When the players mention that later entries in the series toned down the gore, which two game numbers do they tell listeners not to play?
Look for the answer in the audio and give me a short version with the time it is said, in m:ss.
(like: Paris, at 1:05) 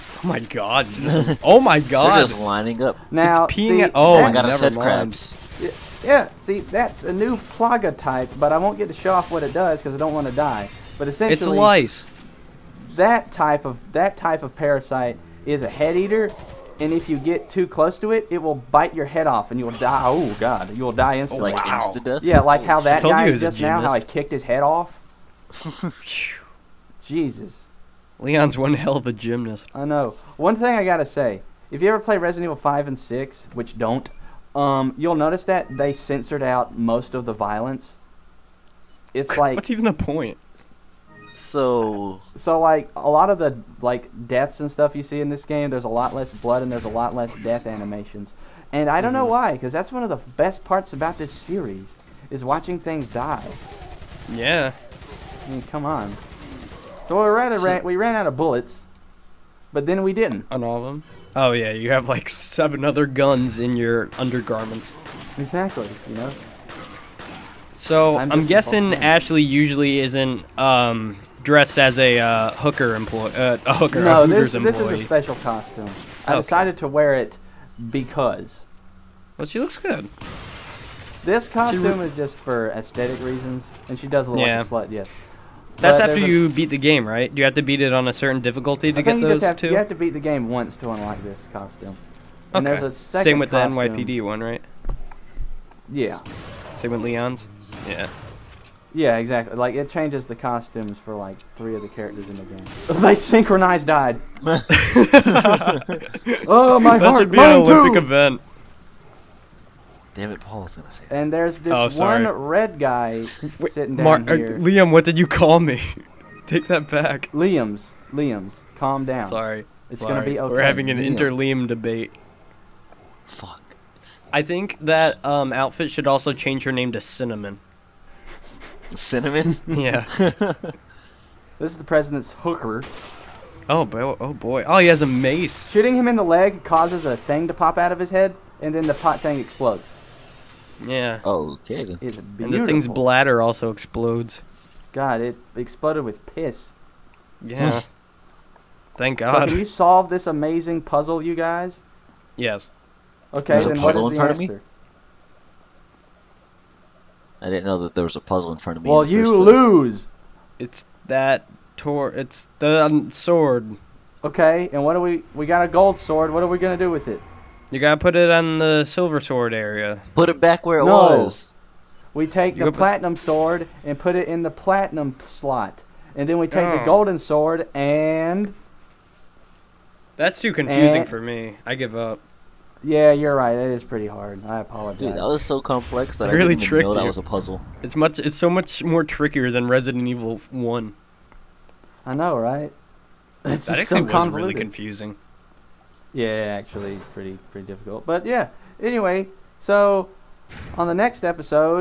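Five and Six, at 0:32.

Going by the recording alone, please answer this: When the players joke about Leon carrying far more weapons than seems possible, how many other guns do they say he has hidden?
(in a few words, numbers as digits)
7.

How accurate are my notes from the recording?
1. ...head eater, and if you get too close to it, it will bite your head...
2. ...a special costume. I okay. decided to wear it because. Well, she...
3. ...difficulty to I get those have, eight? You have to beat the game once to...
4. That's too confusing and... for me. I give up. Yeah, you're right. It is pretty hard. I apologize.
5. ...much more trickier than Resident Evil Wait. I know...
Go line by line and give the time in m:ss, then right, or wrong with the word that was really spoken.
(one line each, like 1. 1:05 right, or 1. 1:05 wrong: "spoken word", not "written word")
1. 0:15 right
2. 1:15 right
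3. 1:28 wrong: "two", not "eight"
4. 3:00 right
5. 3:08 wrong: "One", not "Wait".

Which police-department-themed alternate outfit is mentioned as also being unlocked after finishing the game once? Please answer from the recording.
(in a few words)
NYPD.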